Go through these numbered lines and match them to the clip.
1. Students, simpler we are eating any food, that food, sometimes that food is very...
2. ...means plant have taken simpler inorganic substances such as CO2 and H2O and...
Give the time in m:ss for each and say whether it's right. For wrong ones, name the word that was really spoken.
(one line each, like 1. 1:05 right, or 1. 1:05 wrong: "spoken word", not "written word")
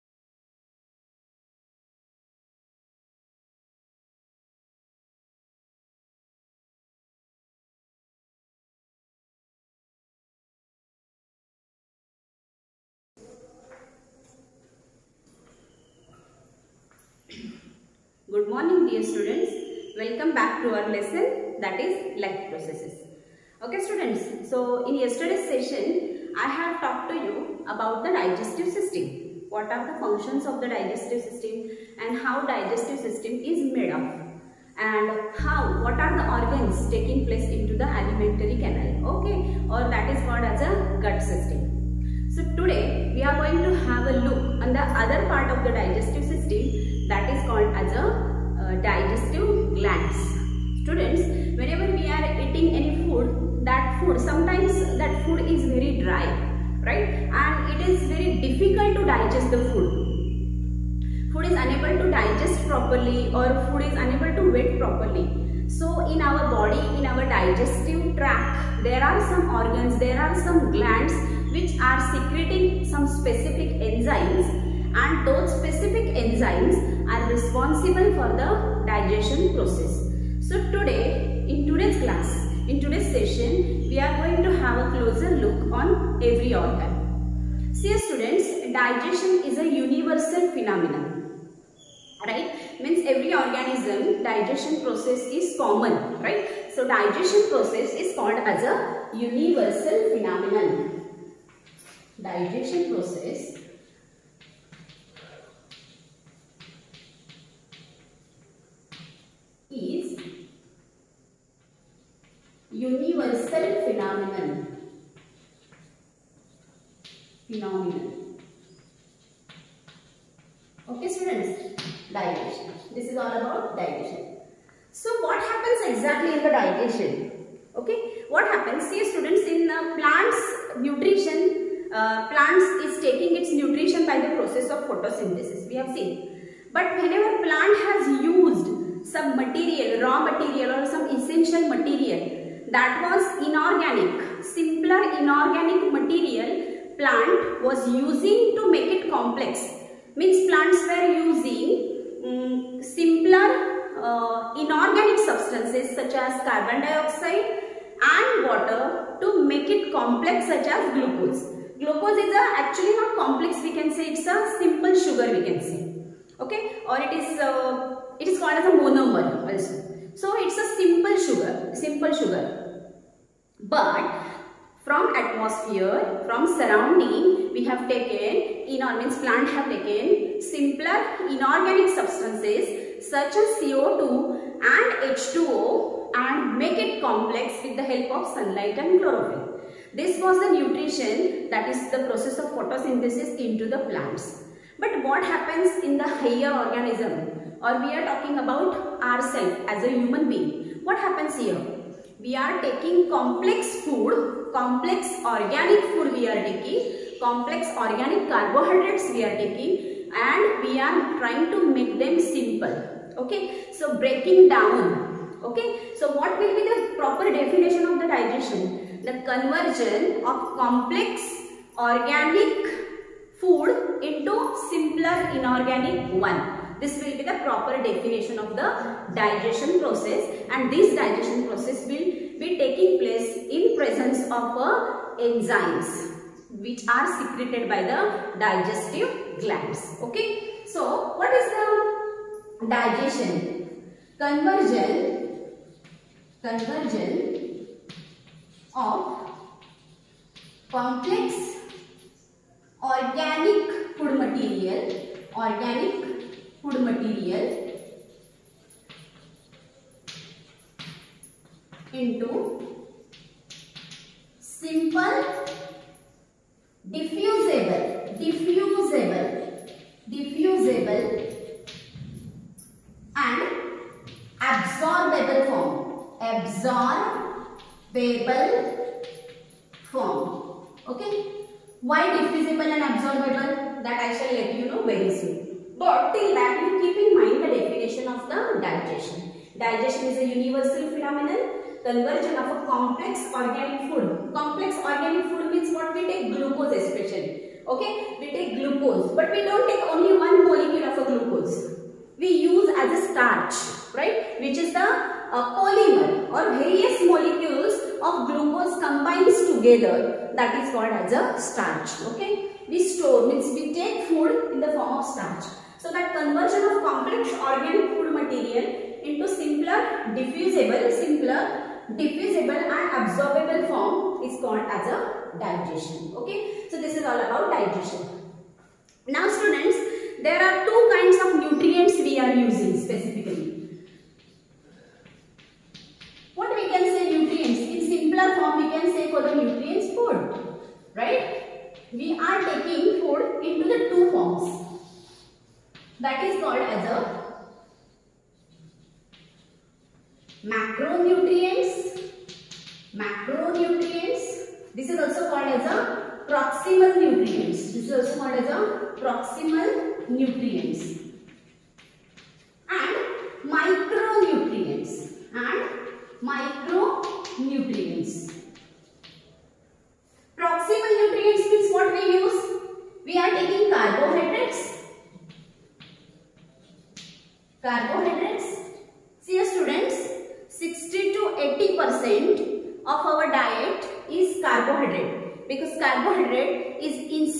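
1. 0:50 wrong: "whenever", not "simpler"
2. 2:58 right.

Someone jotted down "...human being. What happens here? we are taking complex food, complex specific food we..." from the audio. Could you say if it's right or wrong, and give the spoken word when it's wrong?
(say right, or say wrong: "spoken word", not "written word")
wrong: "organic", not "specific".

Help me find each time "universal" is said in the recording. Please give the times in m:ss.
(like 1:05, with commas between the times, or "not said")
1:29, 1:39, 4:50.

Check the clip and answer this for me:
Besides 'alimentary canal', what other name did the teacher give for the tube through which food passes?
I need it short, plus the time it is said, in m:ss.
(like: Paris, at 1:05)
Gut system, at 0:41.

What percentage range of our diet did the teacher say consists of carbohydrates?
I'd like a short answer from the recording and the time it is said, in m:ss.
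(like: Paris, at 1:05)
60 to 80 percent, at 6:20.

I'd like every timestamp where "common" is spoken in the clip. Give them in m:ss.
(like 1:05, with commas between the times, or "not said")
1:35.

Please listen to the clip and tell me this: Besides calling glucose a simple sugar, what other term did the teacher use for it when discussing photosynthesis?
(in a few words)
Monomer.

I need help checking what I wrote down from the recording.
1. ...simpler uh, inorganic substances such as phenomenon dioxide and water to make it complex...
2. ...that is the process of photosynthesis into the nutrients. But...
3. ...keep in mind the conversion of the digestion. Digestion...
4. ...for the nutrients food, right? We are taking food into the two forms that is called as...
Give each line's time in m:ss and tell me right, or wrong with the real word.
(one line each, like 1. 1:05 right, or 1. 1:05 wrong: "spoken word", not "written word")
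1. 2:32 wrong: "carbon", not "phenomenon"
2. 3:11 wrong: "plants", not "nutrients"
3. 4:46 wrong: "definition", not "conversion"
4. 5:39 right.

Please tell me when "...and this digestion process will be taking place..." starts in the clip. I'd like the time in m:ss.
3:50.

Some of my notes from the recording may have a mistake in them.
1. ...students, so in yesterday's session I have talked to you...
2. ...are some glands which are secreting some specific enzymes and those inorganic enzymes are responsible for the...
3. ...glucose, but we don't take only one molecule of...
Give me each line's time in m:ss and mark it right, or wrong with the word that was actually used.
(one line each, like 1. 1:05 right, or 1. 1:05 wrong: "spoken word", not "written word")
1. 0:23 right
2. 1:10 wrong: "specific", not "inorganic"
3. 4:58 right.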